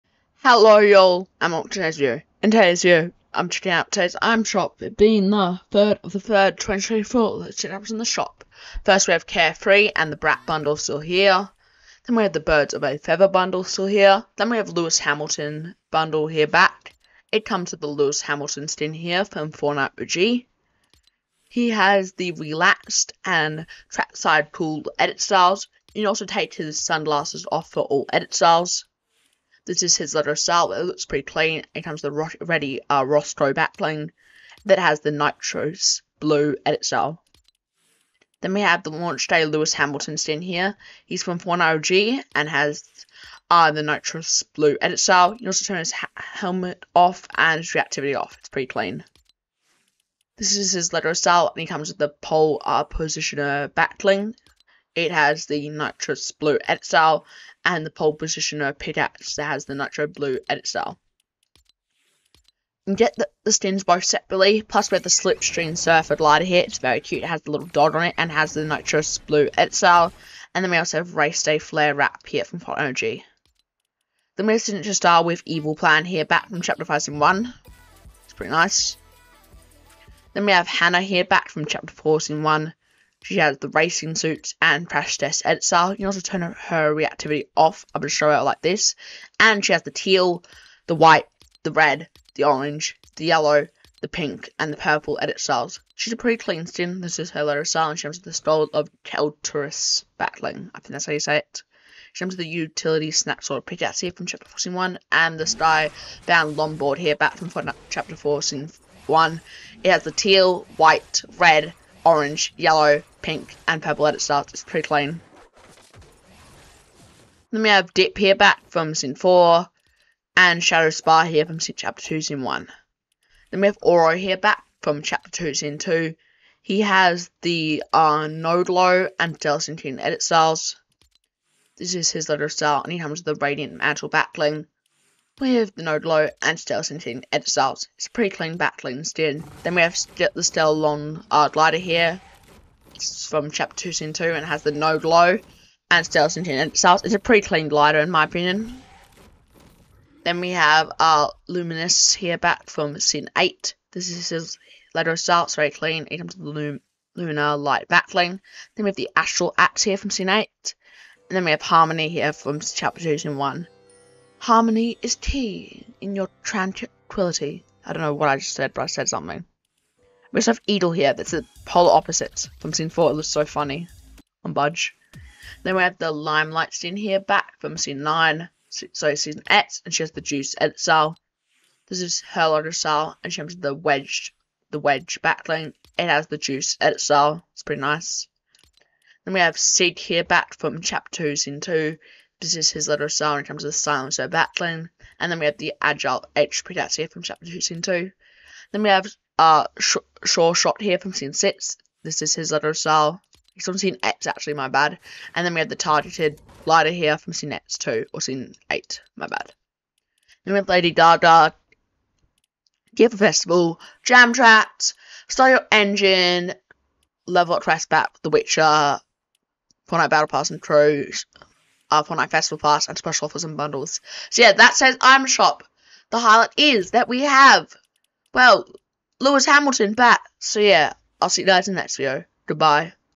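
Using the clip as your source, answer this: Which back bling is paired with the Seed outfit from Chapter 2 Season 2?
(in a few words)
Silencer.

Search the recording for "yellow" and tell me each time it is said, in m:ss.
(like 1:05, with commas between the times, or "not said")
1:33, 1:52.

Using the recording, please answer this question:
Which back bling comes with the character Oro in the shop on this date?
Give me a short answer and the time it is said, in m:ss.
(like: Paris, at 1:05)
Radiant Mantle, at 2:13.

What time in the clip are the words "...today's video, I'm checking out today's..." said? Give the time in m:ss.
0:02.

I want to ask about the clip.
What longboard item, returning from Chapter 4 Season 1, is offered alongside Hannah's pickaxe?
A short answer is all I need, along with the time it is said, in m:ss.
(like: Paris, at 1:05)
Sky Bound Longboard, at 1:45.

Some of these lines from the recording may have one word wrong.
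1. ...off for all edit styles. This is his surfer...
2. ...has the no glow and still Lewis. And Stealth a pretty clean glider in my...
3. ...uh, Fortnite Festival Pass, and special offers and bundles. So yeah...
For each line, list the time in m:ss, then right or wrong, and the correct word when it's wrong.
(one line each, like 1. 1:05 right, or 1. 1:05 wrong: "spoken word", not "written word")
1. 0:27 wrong: "letter", not "surfer"
2. 2:24 wrong: "Engine", not "Lewis"
3. 3:41 right.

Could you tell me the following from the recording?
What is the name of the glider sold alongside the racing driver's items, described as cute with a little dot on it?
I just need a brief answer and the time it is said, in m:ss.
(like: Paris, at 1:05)
Slipstream Surfer, at 1:05.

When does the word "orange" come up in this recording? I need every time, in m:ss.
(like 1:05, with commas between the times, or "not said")
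1:32, 1:52.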